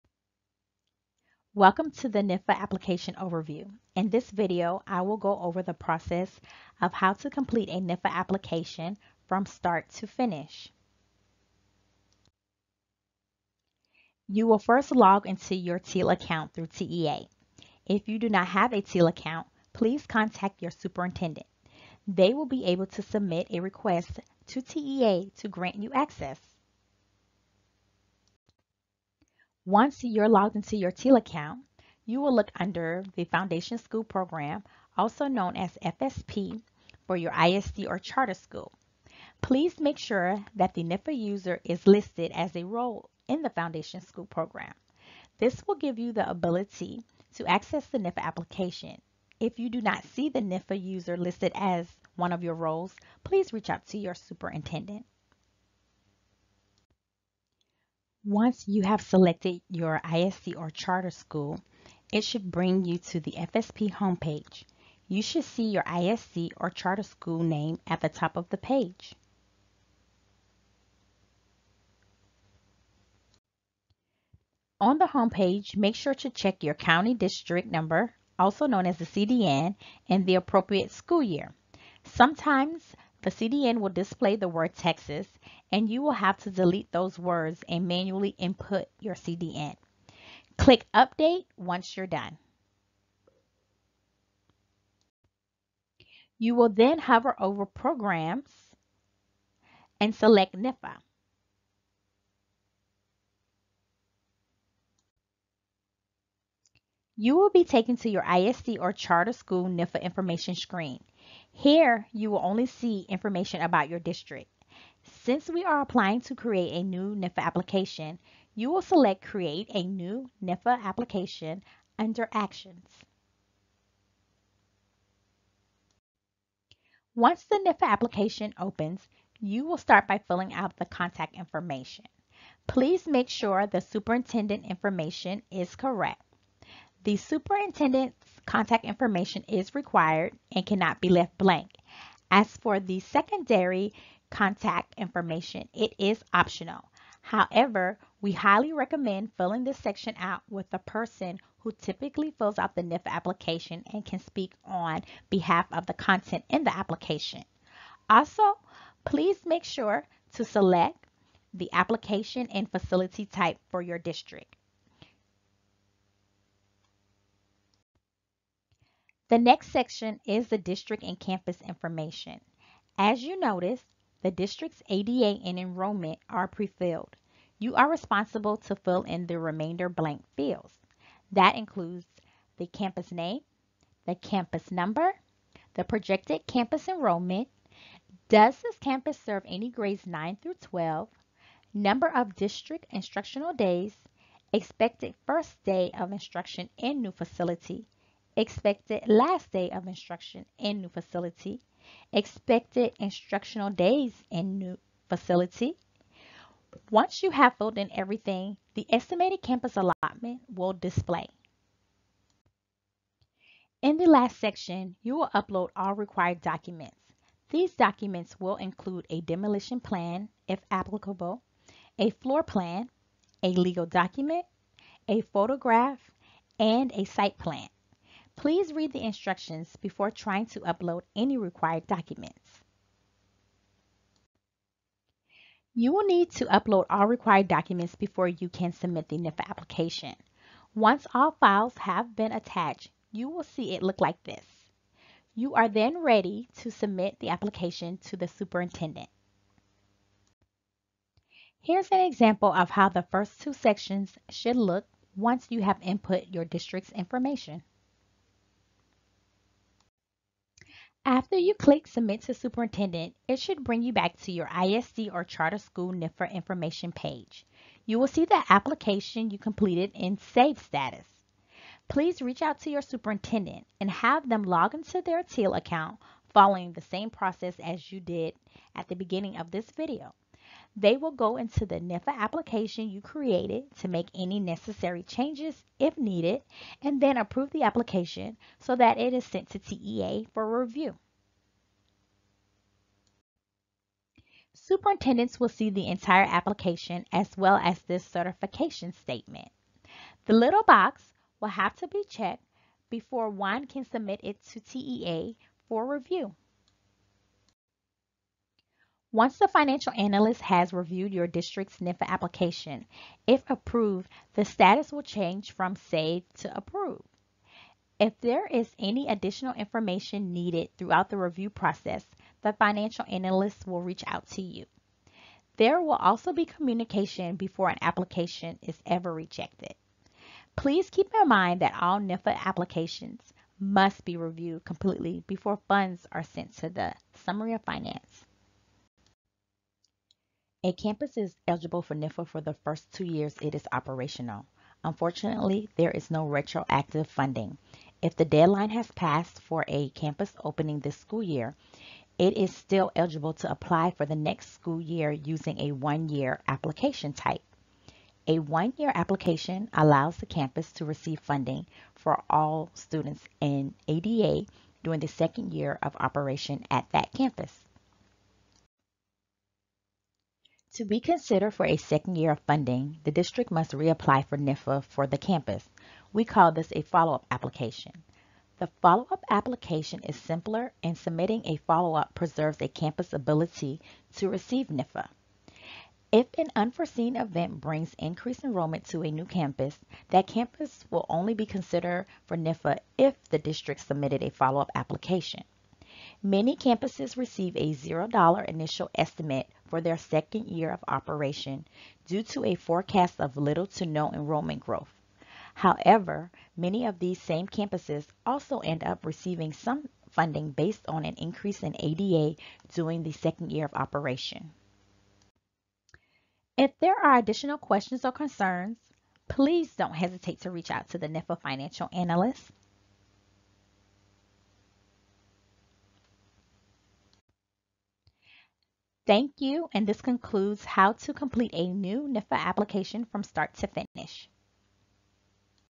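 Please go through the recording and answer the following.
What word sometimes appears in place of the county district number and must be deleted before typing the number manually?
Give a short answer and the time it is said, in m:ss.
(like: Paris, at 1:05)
Texas, at 1:24.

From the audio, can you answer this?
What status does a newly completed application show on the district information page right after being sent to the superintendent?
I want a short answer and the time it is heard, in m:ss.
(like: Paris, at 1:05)
Save, at 4:30.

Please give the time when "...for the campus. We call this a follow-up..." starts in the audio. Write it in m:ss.
6:14.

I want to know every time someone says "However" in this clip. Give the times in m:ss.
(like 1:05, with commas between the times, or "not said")
2:27, 6:45.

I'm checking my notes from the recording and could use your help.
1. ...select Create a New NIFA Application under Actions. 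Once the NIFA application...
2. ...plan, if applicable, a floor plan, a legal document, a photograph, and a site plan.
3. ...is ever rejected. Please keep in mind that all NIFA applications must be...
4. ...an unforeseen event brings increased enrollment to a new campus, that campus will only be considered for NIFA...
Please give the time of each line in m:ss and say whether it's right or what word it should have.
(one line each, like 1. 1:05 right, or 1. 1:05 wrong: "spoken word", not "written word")
1. 1:58 right
2. 3:39 right
3. 5:28 right
4. 6:26 right.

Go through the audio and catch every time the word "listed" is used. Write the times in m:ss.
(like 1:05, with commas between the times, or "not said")
0:41, 0:51.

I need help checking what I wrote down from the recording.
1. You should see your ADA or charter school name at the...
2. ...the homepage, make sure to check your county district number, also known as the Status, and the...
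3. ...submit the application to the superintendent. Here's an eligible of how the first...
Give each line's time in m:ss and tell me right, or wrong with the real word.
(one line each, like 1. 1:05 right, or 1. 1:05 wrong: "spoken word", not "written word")
1. 1:05 wrong: "ISD", not "ADA"
2. 1:14 wrong: "CDN", not "Status"
3. 4:06 wrong: "example", not "eligible".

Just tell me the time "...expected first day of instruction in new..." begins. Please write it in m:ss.
3:14.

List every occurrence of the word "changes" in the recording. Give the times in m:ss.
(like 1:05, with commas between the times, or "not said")
4:45, 5:15.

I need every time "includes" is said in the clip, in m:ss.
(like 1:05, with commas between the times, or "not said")
3:01, 3:38.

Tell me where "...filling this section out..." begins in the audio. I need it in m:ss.
2:29.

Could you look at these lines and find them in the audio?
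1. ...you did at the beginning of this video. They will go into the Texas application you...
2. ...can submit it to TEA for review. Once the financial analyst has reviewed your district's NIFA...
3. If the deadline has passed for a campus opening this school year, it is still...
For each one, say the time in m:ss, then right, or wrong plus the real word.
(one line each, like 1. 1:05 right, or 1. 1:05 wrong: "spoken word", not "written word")
1. 4:37 wrong: "NIFA", not "Texas"
2. 5:03 right
3. 5:47 right.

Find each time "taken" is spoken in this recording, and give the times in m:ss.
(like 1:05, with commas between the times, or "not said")
1:47.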